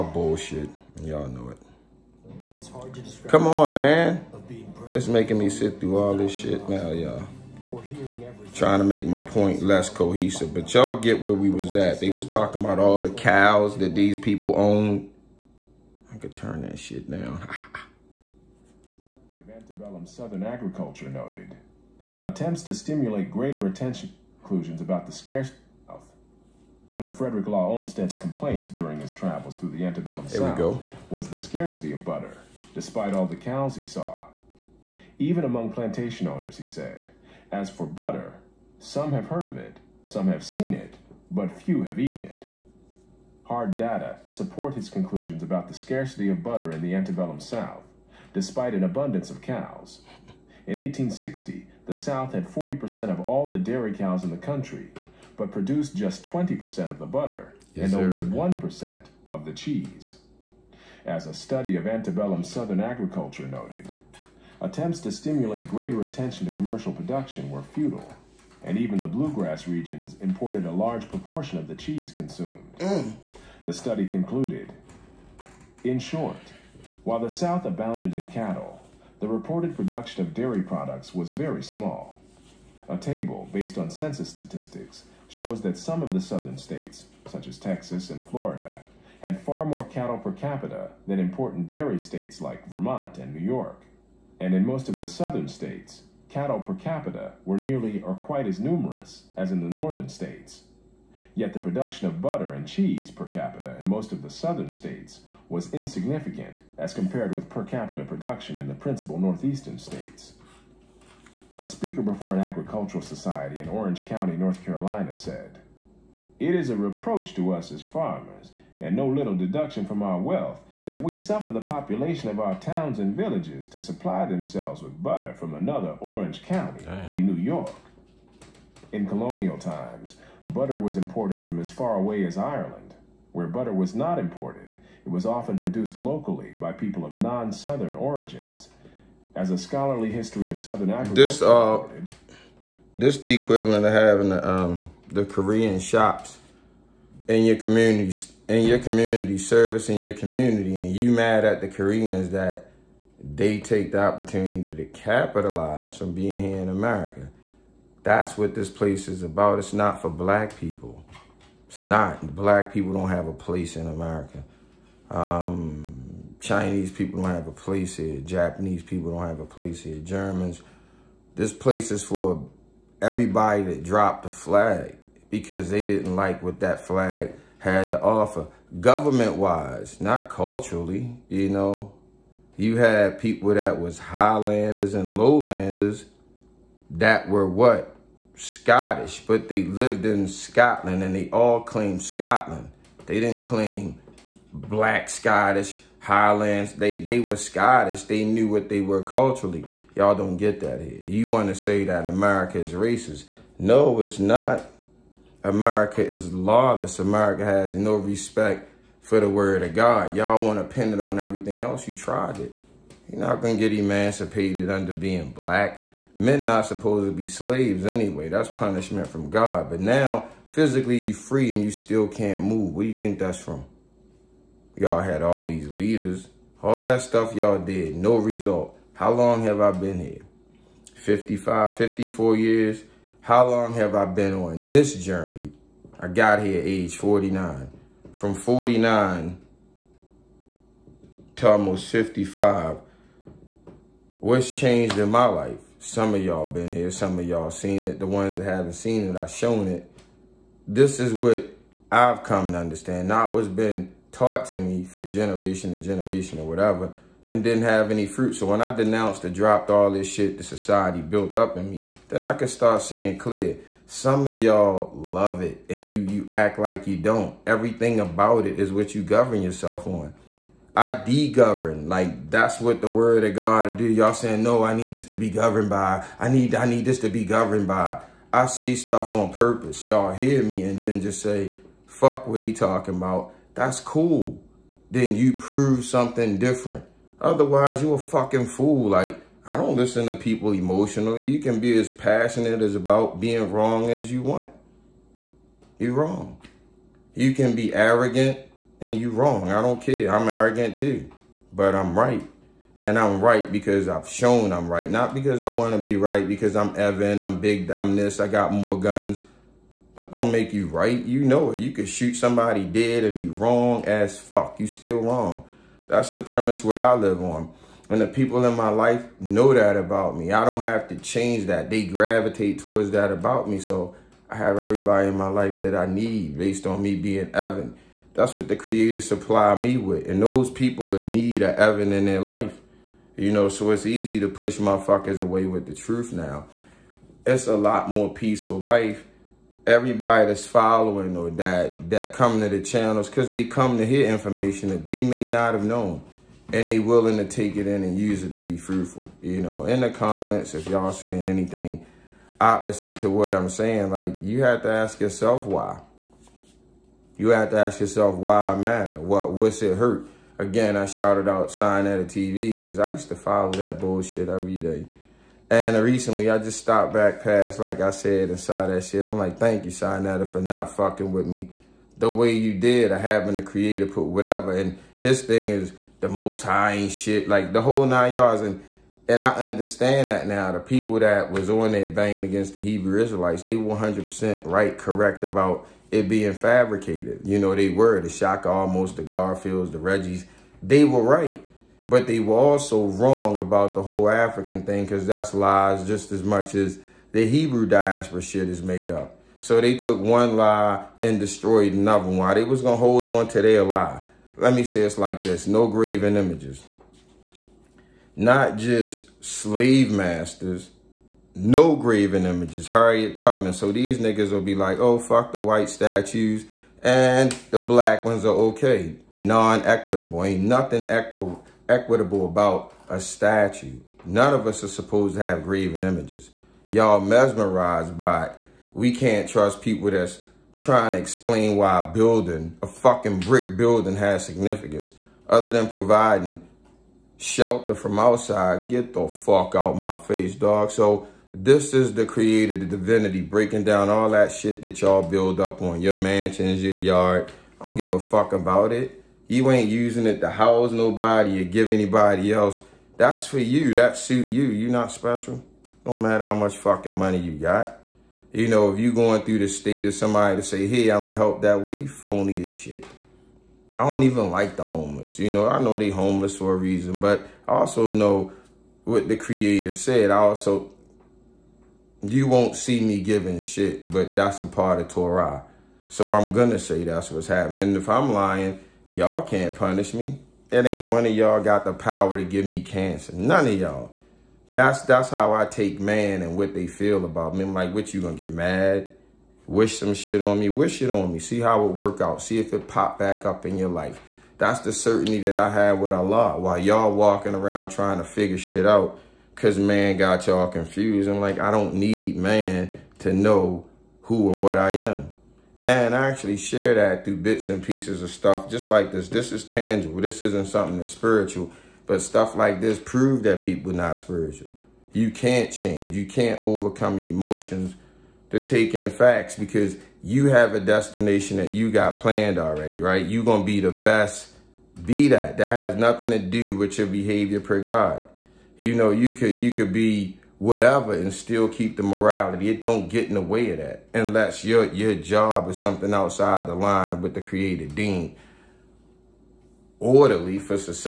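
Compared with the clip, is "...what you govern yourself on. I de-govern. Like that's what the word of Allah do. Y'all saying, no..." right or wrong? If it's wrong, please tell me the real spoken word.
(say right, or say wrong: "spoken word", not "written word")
wrong: "God", not "Allah".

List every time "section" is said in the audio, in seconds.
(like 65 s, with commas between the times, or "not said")
not said.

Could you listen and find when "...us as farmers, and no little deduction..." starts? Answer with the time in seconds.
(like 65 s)
117 s.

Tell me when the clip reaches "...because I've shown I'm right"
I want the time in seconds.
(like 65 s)
303 s.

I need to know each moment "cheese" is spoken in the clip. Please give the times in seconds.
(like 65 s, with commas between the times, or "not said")
59 s, 71 s, 102 s.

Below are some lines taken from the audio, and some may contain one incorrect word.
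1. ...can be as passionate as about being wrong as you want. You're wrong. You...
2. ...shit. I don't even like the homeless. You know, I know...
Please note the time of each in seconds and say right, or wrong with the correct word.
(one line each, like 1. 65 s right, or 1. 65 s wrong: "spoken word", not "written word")
1. 291 s right
2. 462 s right.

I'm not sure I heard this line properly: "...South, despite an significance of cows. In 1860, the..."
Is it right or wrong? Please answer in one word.
wrong.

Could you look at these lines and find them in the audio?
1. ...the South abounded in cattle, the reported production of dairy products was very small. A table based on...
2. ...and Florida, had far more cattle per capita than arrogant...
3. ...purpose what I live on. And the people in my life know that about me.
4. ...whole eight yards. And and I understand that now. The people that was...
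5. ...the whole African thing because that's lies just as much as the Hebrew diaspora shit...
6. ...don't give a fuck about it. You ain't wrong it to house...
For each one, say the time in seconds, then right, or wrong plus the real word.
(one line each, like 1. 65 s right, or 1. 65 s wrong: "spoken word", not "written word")
1. 77 s right
2. 88 s wrong: "important", not "arrogant"
3. 316 s wrong: "premise", not "purpose"
4. 377 s wrong: "nine", not "eight"
5. 393 s right
6. 447 s wrong: "using", not "wrong".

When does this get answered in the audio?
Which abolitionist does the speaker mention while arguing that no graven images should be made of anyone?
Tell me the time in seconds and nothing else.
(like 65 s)
412 s.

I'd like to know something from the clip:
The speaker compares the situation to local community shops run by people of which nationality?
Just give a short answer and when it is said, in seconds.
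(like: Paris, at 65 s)
Korean, at 145 s.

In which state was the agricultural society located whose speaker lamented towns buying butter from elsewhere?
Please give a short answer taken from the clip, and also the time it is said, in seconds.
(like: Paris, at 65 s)
North Carolina, at 114 s.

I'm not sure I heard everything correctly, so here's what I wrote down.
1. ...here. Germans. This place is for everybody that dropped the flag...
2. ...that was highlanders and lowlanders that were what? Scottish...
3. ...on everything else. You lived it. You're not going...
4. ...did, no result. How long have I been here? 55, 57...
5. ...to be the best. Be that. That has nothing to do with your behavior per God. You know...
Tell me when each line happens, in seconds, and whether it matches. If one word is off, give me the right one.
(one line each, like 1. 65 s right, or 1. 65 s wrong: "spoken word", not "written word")
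1. 169 s right
2. 183 s right
3. 210 s wrong: "tried", not "lived"
4. 227 s wrong: "54", not "57"
5. 523 s right.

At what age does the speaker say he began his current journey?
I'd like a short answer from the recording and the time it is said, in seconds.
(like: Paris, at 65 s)
49, at 236 s.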